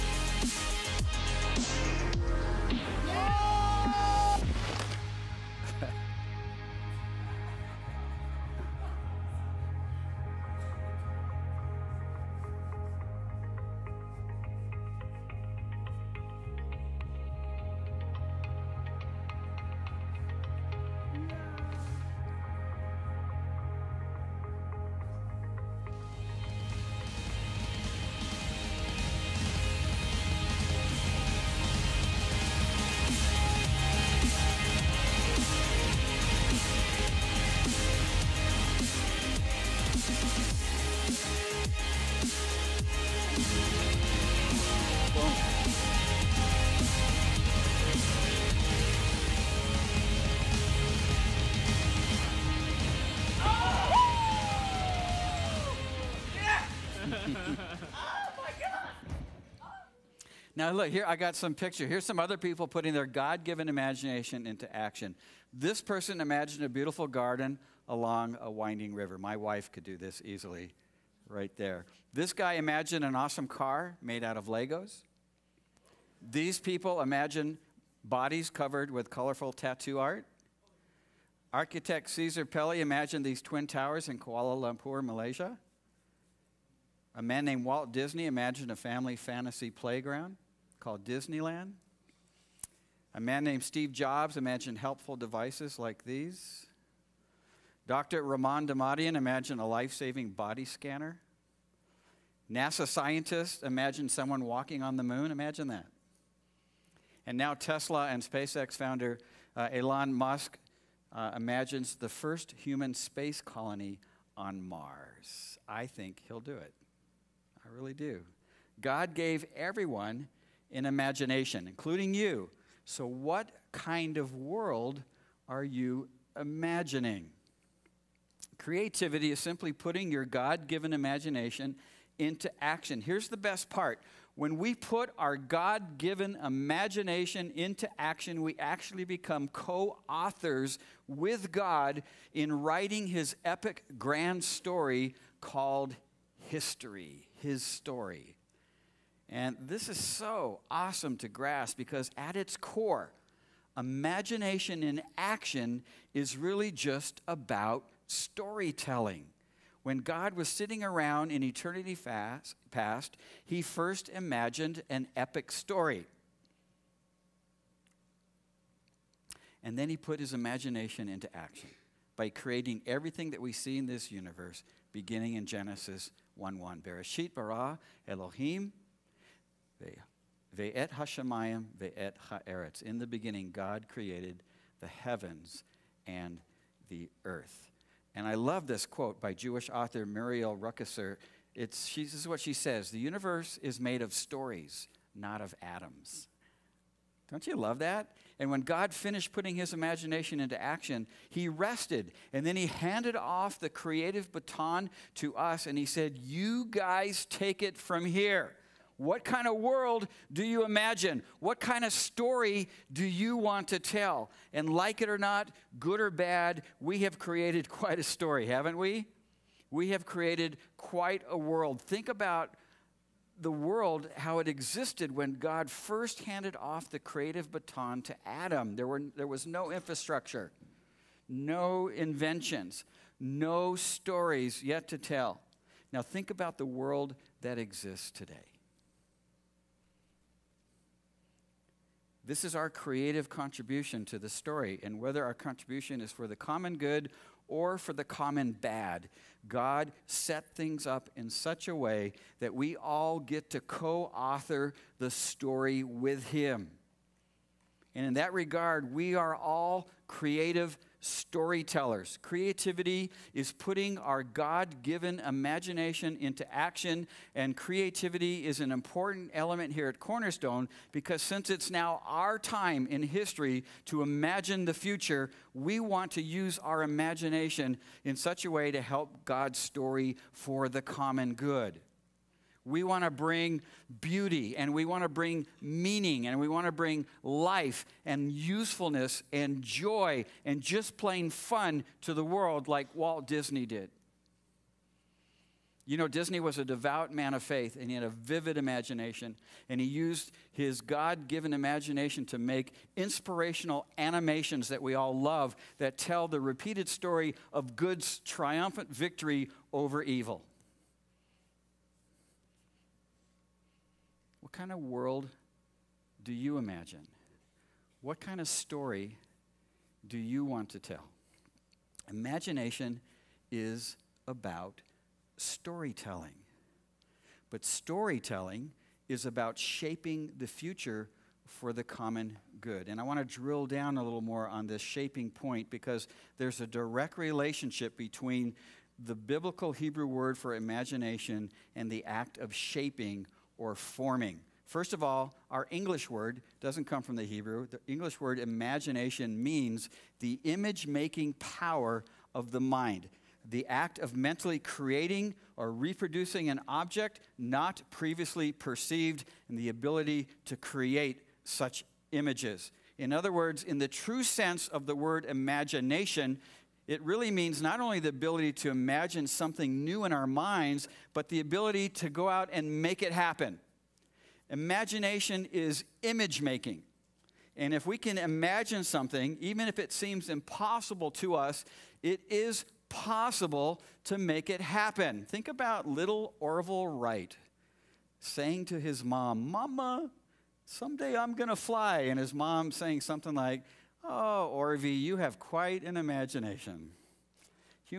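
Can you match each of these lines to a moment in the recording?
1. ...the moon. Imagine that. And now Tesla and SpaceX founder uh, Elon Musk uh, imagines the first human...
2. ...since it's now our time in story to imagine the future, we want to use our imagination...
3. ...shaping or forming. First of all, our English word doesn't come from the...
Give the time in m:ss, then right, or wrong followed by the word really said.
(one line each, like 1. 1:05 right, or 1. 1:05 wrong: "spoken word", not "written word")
1. 1:44 right
2. 4:31 wrong: "history", not "story"
3. 5:42 right.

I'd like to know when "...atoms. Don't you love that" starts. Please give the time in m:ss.
3:15.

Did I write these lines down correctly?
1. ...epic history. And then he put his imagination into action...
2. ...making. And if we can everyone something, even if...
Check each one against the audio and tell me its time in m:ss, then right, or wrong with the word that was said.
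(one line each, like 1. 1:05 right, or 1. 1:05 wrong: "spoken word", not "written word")
1. 2:45 wrong: "story", not "history"
2. 6:16 wrong: "imagine", not "everyone".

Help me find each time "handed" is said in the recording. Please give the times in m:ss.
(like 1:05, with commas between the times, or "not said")
3:22, 3:46.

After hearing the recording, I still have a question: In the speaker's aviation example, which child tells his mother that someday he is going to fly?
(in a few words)
Orville Wright.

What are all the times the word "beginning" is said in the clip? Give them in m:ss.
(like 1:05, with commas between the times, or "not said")
2:54, 3:03.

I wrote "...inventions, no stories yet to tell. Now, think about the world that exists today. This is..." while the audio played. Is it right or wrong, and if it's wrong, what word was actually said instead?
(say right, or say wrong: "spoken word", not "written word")
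right.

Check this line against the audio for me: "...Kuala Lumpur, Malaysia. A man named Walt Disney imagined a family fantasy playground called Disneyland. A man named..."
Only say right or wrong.
right.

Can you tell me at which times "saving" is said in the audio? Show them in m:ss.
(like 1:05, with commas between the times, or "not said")
1:39.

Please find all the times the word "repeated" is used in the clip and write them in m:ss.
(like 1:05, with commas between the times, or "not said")
5:06.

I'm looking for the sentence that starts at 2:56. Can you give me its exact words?
Bereshit bara Elohim Ve-et hashemayim, ve-et ha'aretz.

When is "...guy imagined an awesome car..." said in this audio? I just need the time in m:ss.
1:12.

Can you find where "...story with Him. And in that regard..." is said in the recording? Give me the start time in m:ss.
4:15.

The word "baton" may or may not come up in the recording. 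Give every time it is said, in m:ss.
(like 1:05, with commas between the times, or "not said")
3:24, 3:47.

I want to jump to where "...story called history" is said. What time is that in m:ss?
2:24.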